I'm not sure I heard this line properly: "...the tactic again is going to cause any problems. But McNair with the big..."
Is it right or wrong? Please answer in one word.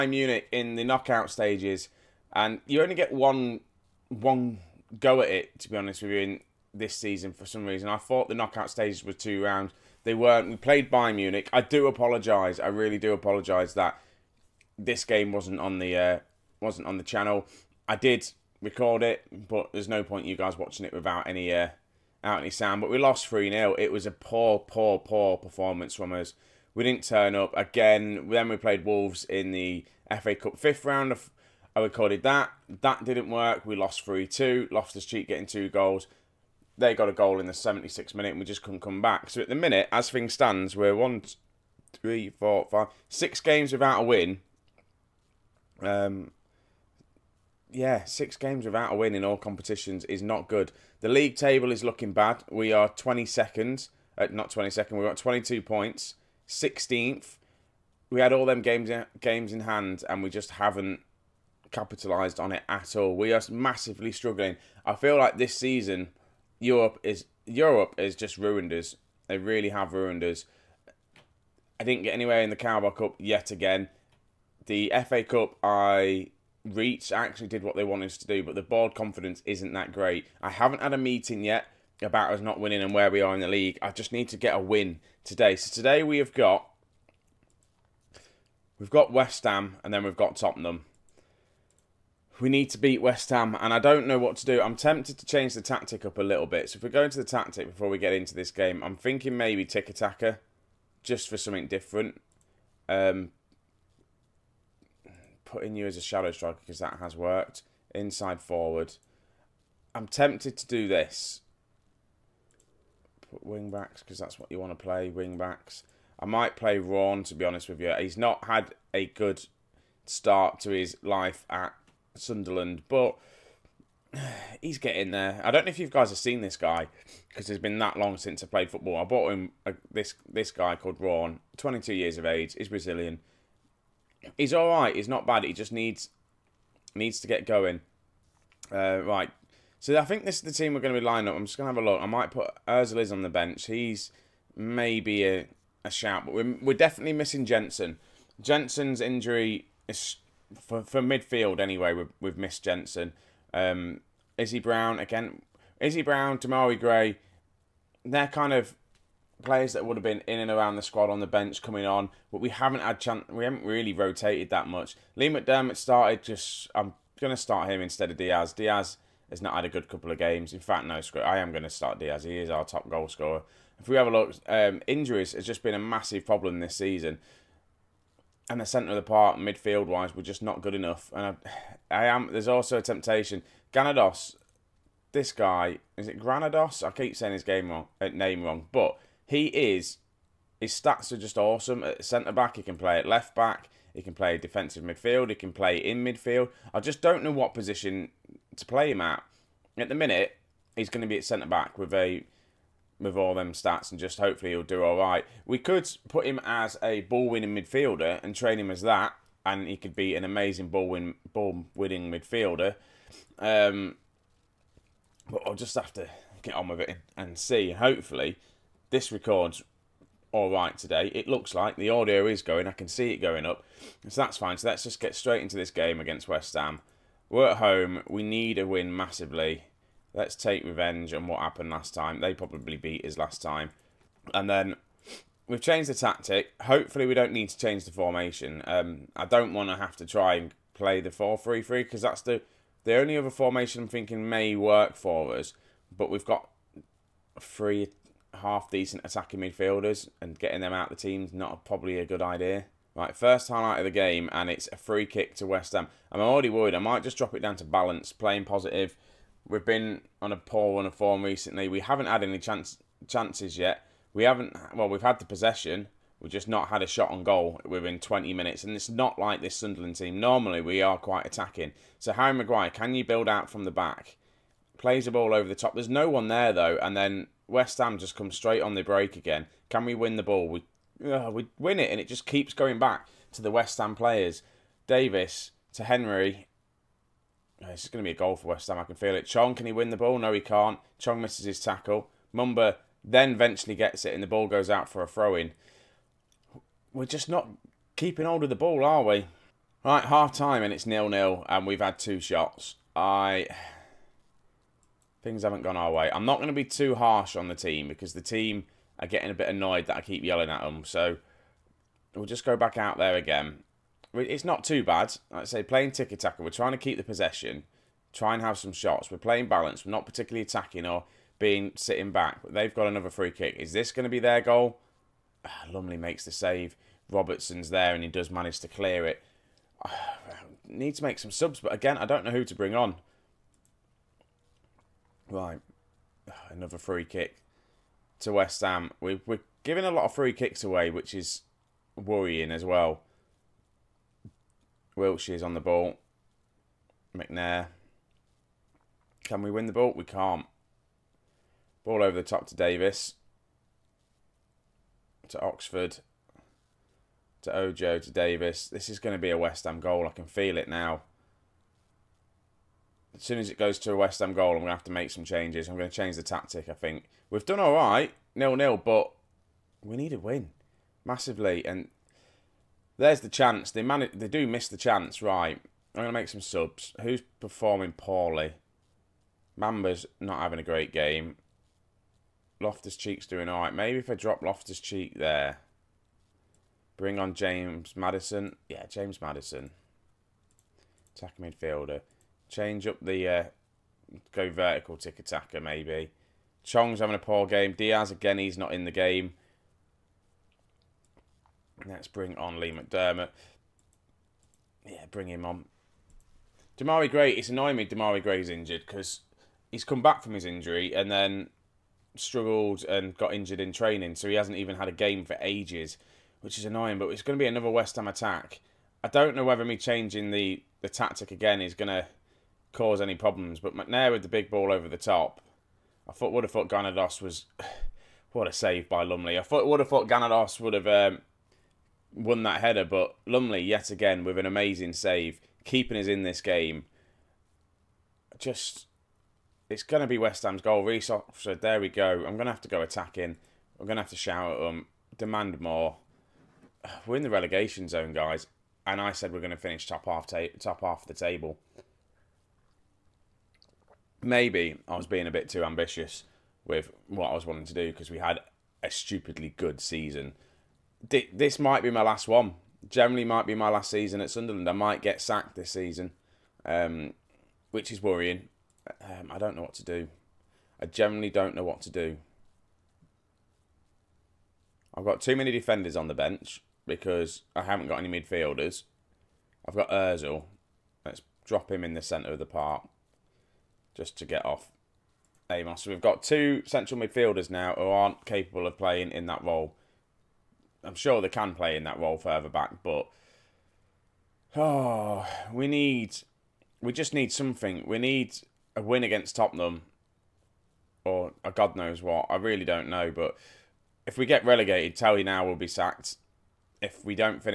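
right.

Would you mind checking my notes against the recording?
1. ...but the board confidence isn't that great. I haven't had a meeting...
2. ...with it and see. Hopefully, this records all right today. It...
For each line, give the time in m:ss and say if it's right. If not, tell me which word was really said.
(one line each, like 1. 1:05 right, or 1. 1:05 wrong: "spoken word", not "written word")
1. 1:18 right
2. 3:36 right.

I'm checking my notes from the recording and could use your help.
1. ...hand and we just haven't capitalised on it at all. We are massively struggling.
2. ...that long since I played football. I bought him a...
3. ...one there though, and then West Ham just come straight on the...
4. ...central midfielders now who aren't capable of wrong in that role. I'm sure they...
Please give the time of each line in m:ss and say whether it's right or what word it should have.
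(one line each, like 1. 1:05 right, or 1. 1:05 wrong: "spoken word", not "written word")
1. 0:59 right
2. 2:07 right
3. 4:36 right
4. 8:06 wrong: "playing", not "wrong".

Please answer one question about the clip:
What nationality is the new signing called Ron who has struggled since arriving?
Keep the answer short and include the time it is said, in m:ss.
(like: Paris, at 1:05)
Brazilian, at 2:12.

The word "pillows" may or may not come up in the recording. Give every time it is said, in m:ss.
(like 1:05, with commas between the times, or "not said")
not said.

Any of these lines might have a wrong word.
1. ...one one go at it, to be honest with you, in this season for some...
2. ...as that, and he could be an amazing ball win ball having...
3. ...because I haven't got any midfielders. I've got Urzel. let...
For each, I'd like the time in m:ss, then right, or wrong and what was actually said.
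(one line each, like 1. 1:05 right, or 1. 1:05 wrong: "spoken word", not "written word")
1. 0:03 right
2. 3:28 wrong: "winning", not "having"
3. 7:56 right.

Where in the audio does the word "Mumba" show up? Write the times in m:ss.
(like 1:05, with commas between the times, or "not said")
4:52, 6:19.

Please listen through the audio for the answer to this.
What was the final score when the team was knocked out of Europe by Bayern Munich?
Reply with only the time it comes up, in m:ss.
0:23.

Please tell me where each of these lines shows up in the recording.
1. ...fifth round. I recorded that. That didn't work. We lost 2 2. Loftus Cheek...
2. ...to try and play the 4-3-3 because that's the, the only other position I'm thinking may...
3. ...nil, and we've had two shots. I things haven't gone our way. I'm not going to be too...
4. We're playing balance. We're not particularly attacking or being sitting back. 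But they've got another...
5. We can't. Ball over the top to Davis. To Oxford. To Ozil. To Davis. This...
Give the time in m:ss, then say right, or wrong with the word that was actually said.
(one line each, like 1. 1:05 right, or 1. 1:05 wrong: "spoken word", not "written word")
1. 0:30 wrong: "3", not "2"
2. 3:59 wrong: "formation", not "position"
3. 5:01 right
4. 5:19 right
5. 5:49 wrong: "Ojo", not "Ozil".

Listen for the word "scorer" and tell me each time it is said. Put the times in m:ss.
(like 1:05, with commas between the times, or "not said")
2:53.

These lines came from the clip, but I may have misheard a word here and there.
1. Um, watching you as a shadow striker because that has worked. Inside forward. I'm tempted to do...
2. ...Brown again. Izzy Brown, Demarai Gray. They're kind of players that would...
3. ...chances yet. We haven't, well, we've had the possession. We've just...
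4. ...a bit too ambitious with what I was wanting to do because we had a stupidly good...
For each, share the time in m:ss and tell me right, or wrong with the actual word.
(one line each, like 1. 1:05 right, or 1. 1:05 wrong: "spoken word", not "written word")
1. 1:42 wrong: "putting", not "watching"
2. 2:34 right
3. 4:23 right
4. 7:35 right.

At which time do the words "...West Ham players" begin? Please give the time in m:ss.
4:43.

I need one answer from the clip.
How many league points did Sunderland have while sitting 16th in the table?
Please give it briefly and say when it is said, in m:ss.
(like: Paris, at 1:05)
22, at 0:55.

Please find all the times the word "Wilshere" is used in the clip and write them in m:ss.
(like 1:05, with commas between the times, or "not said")
5:44.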